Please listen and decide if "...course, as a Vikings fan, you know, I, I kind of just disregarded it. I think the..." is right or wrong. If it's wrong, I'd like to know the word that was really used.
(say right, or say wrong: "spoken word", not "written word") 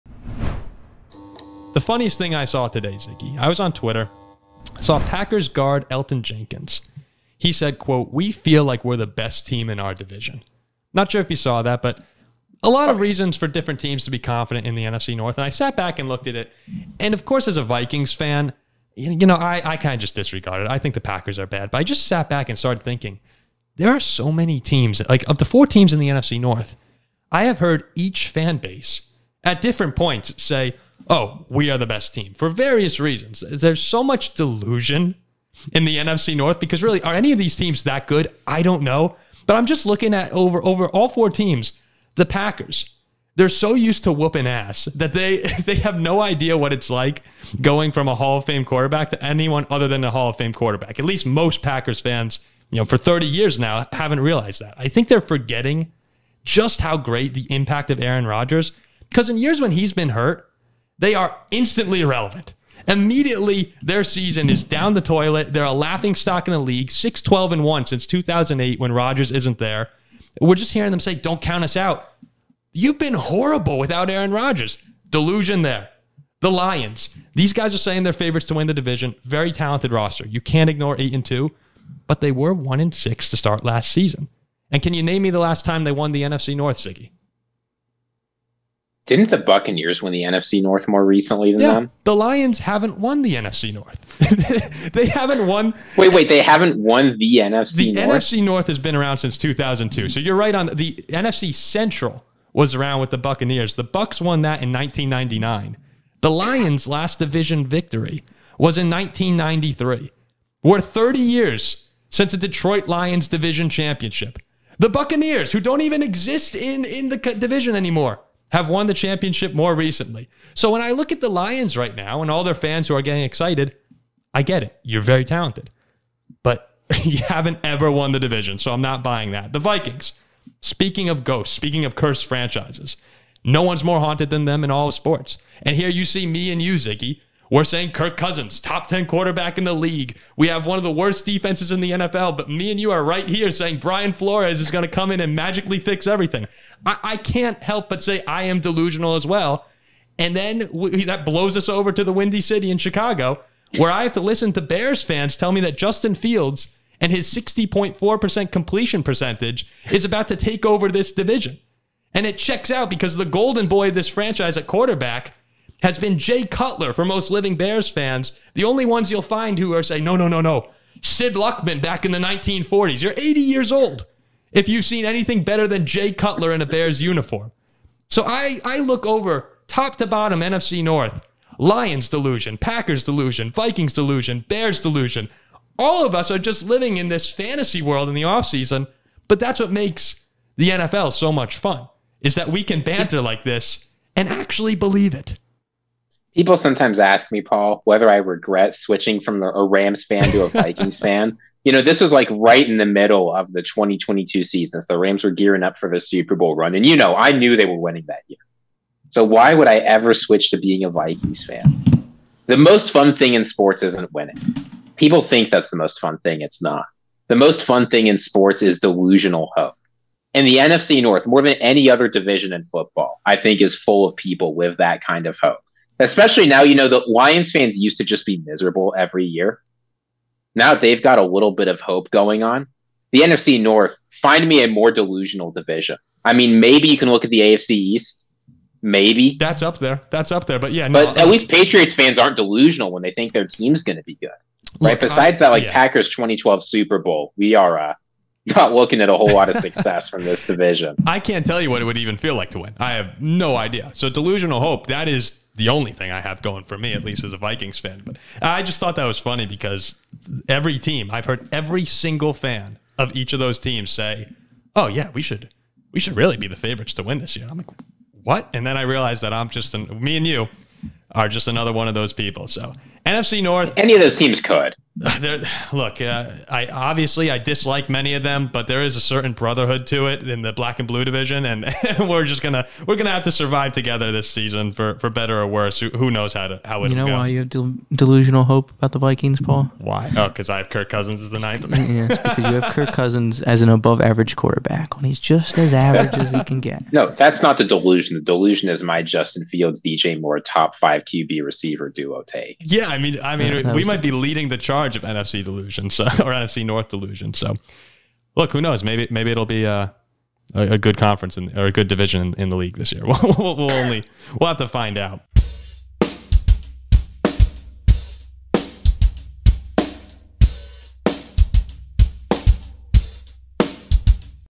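right.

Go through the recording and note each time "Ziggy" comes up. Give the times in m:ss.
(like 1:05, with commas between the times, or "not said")
0:02, 1:26, 2:16.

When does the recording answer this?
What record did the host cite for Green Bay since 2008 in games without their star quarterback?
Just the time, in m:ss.
1:06.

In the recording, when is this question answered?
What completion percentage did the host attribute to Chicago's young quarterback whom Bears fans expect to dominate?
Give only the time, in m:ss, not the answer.
2:37.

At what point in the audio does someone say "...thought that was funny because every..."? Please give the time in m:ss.
4:18.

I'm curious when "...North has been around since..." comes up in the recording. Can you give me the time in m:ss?
1:38.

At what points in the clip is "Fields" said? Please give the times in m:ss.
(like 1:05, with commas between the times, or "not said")
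2:36, 4:59.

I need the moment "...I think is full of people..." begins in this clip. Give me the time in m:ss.
3:43.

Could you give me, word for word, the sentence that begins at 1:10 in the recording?
We're just hearing them say, don't count us out.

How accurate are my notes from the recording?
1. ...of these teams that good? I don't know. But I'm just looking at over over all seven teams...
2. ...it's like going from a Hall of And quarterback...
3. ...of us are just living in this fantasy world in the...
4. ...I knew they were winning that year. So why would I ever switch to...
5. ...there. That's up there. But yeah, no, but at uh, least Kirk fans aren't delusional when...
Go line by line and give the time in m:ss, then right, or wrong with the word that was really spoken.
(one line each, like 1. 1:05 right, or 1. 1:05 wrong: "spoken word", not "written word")
1. 0:37 wrong: "four", not "seven"
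2. 0:46 wrong: "Fame", not "And"
3. 3:06 right
4. 3:27 right
5. 3:59 wrong: "Patriots", not "Kirk".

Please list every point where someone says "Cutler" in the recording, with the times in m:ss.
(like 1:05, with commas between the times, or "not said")
2:46, 2:56.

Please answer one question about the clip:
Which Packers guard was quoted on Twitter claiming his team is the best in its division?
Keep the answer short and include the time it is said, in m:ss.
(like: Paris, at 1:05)
Elgton Jenkins, at 0:05.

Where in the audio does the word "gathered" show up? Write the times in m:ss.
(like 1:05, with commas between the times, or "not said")
not said.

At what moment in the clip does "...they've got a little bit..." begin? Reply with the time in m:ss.
3:50.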